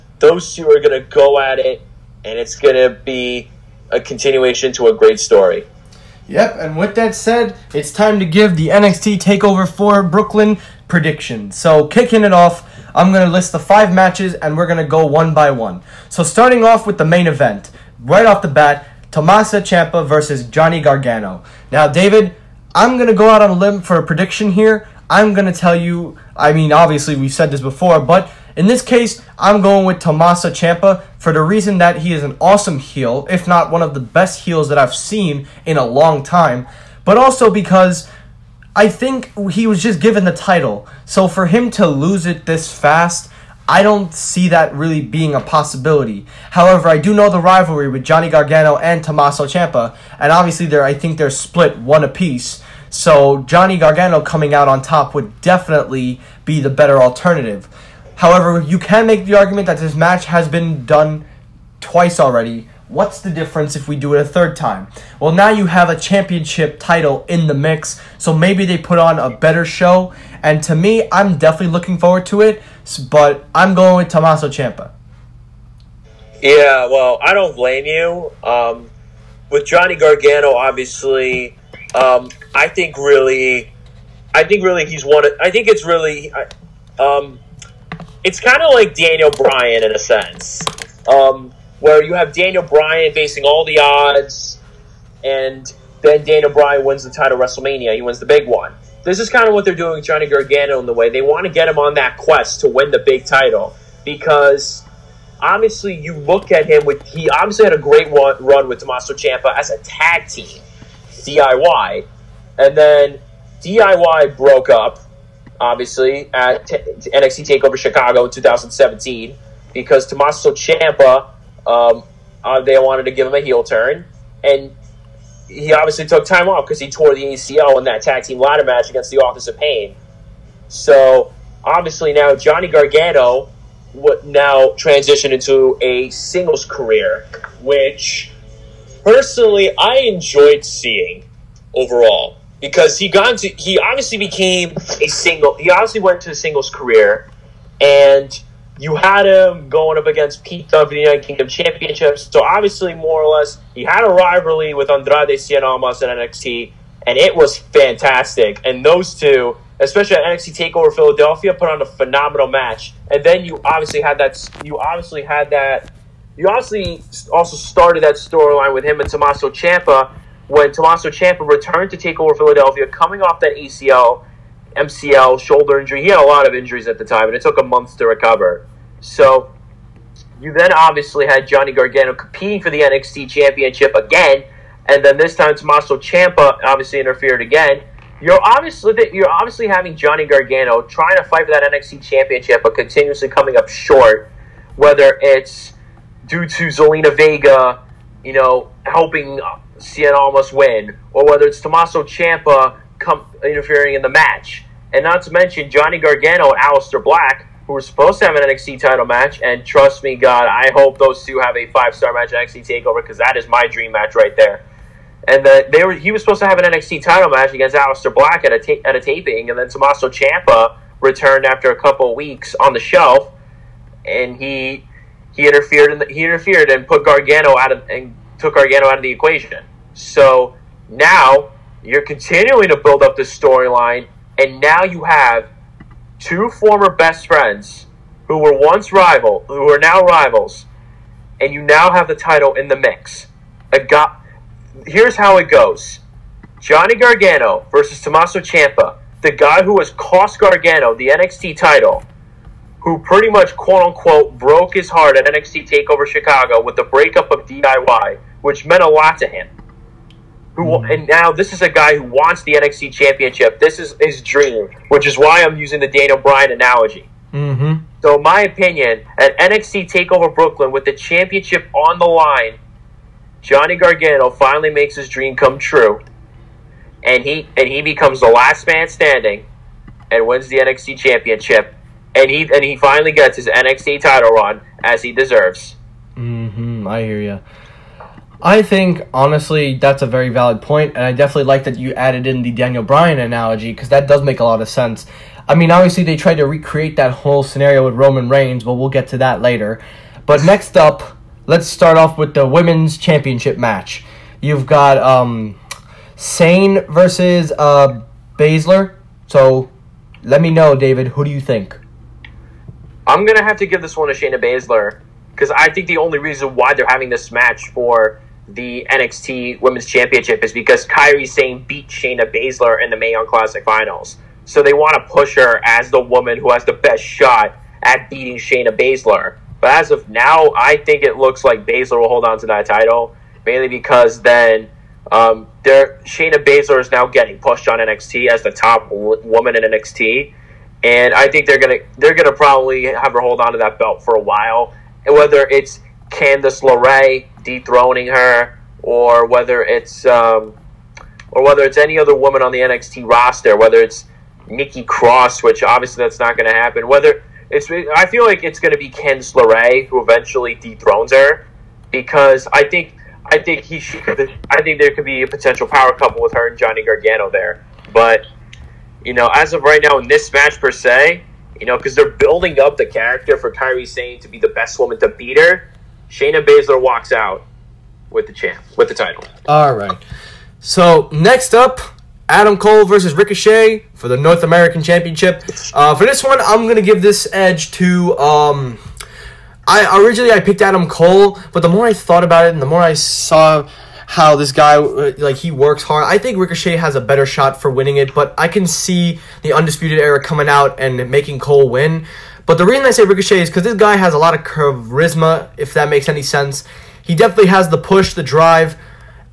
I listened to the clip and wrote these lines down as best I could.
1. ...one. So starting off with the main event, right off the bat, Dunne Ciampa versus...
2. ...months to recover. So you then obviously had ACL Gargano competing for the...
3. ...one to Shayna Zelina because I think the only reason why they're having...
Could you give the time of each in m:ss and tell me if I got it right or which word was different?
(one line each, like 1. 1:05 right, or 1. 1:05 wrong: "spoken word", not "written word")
1. 0:15 wrong: "Tommaso", not "Dunne"
2. 2:57 wrong: "Johnny", not "ACL"
3. 5:13 wrong: "Baszler", not "Zelina".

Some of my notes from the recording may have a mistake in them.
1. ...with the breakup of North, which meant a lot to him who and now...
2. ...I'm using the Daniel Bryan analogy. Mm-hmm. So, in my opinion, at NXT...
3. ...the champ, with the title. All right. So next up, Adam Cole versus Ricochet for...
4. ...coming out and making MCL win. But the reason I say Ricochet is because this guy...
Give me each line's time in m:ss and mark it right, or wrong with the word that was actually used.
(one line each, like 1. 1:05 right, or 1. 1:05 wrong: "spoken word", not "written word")
1. 4:16 wrong: "DIY", not "North"
2. 4:25 right
3. 6:18 right
4. 6:40 wrong: "Cole", not "MCL".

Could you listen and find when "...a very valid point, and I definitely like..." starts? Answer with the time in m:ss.
4:50.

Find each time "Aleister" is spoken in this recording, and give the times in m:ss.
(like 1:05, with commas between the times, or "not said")
3:26, 3:37.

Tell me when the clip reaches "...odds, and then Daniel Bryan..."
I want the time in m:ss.
1:33.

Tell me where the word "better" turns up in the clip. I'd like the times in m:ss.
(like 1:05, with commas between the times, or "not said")
0:56, 1:09, 6:37.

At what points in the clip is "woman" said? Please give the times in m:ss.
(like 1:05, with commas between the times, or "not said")
5:26, 5:39, 5:52, 6:14.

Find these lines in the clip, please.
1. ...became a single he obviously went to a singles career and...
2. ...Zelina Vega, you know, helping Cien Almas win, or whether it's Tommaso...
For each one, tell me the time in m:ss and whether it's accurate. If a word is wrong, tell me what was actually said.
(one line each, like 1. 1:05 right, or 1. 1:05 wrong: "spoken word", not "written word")
1. 2:24 right
2. 3:16 right.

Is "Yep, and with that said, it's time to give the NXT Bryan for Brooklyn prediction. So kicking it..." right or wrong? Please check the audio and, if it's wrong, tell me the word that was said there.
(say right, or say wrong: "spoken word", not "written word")
wrong: "Takeover", not "Bryan".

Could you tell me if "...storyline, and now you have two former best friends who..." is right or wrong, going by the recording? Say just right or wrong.
right.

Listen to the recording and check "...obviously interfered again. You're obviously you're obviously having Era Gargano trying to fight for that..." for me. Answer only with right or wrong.
wrong.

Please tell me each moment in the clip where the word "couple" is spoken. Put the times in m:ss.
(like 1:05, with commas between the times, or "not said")
3:41, 6:05.